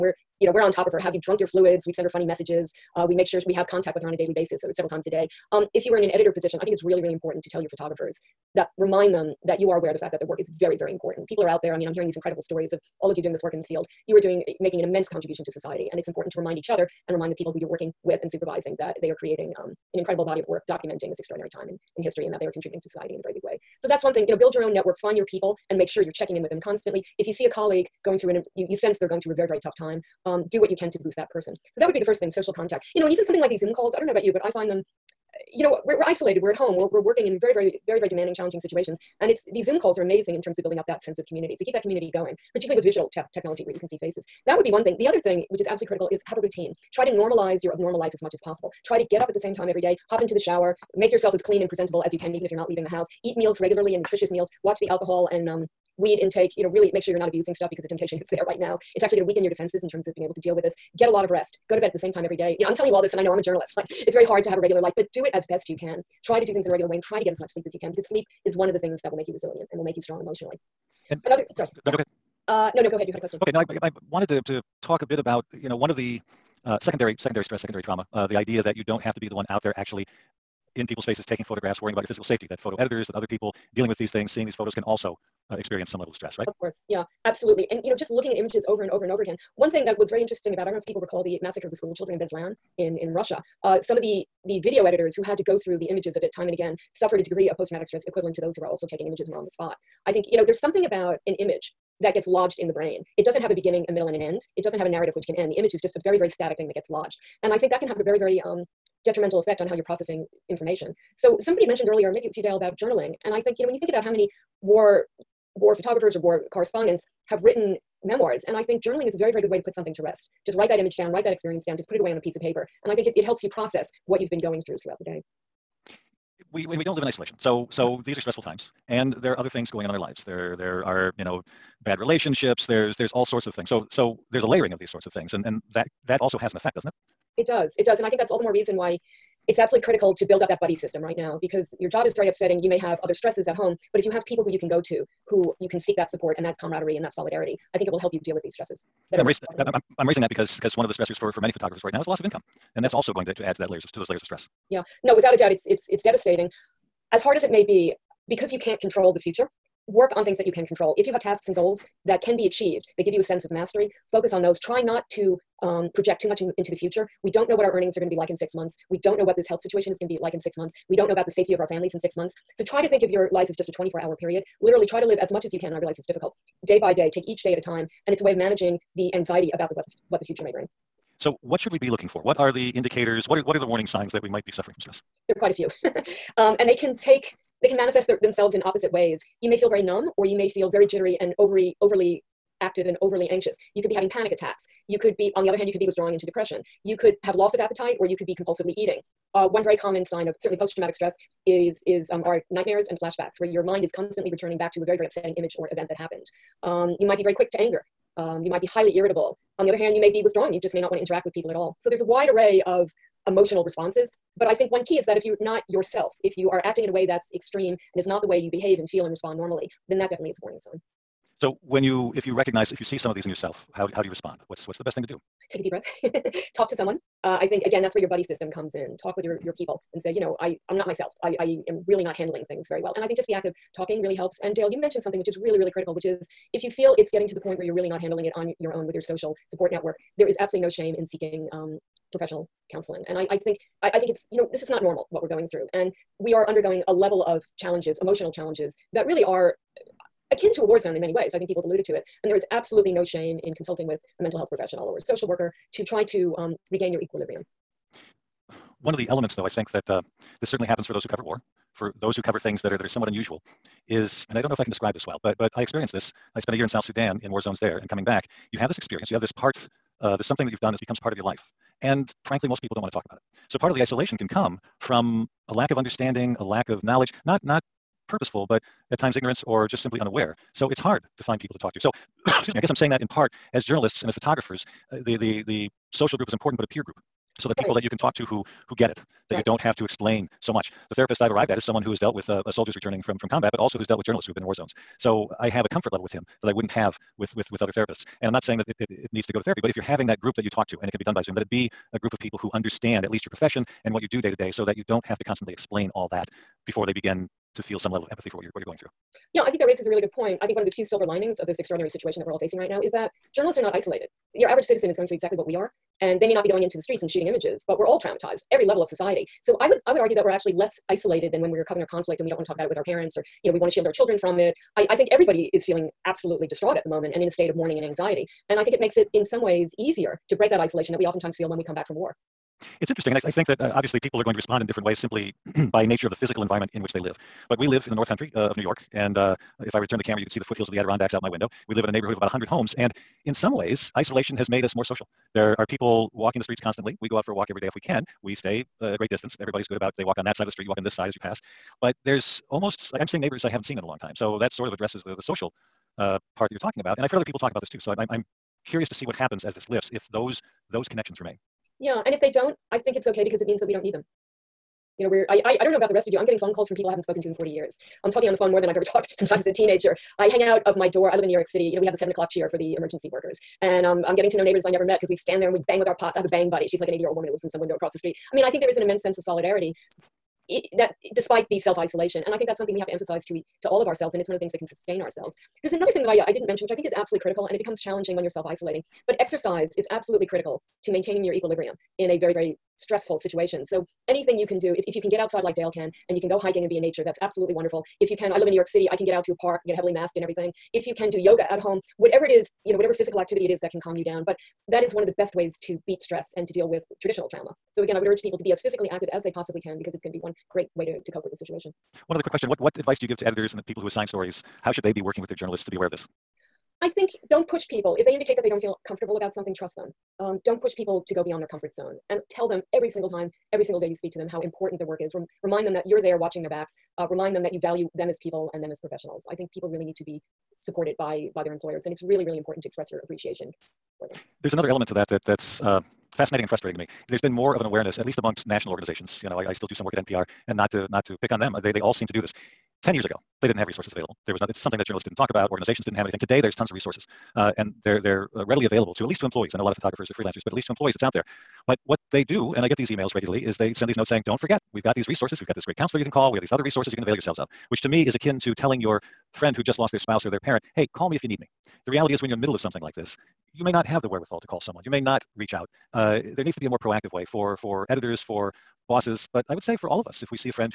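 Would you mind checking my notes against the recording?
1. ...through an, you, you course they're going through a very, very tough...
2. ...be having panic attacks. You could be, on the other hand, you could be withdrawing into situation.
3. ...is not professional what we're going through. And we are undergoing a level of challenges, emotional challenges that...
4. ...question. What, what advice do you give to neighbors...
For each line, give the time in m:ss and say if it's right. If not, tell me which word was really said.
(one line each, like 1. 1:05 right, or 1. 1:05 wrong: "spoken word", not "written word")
1. 0:28 wrong: "sense", not "course"
2. 3:13 wrong: "depression", not "situation"
3. 4:04 wrong: "normal", not "professional"
4. 6:52 wrong: "editors", not "neighbors".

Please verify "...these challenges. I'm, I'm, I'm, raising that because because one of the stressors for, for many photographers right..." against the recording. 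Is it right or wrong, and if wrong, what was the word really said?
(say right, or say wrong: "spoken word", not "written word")
wrong: "stresses", not "challenges".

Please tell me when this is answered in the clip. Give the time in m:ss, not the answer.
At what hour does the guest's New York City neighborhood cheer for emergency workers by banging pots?
6:11.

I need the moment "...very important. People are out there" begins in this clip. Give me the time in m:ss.
0:10.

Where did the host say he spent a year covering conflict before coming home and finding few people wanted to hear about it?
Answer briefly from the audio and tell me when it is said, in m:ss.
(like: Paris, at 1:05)
South Sudan, at 4:26.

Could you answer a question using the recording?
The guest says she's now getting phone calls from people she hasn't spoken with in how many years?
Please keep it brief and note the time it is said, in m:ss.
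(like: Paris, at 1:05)
40, at 6:07.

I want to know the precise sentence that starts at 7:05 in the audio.
Rem- remind them that you're there watching their backs.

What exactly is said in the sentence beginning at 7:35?
We've got this great counselor you can call.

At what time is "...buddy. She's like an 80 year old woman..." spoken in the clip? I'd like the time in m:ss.
6:16.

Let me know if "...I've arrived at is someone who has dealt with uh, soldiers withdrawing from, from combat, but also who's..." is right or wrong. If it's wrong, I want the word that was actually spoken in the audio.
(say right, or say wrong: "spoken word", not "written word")
wrong: "returning", not "withdrawing".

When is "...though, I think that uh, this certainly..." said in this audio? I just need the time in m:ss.
4:19.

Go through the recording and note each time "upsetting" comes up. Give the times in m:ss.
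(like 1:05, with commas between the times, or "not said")
2:22, 3:25.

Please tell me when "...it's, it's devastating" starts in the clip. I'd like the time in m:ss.
2:35.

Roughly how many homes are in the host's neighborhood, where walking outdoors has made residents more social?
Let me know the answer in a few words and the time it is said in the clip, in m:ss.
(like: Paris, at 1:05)
100, at 5:42.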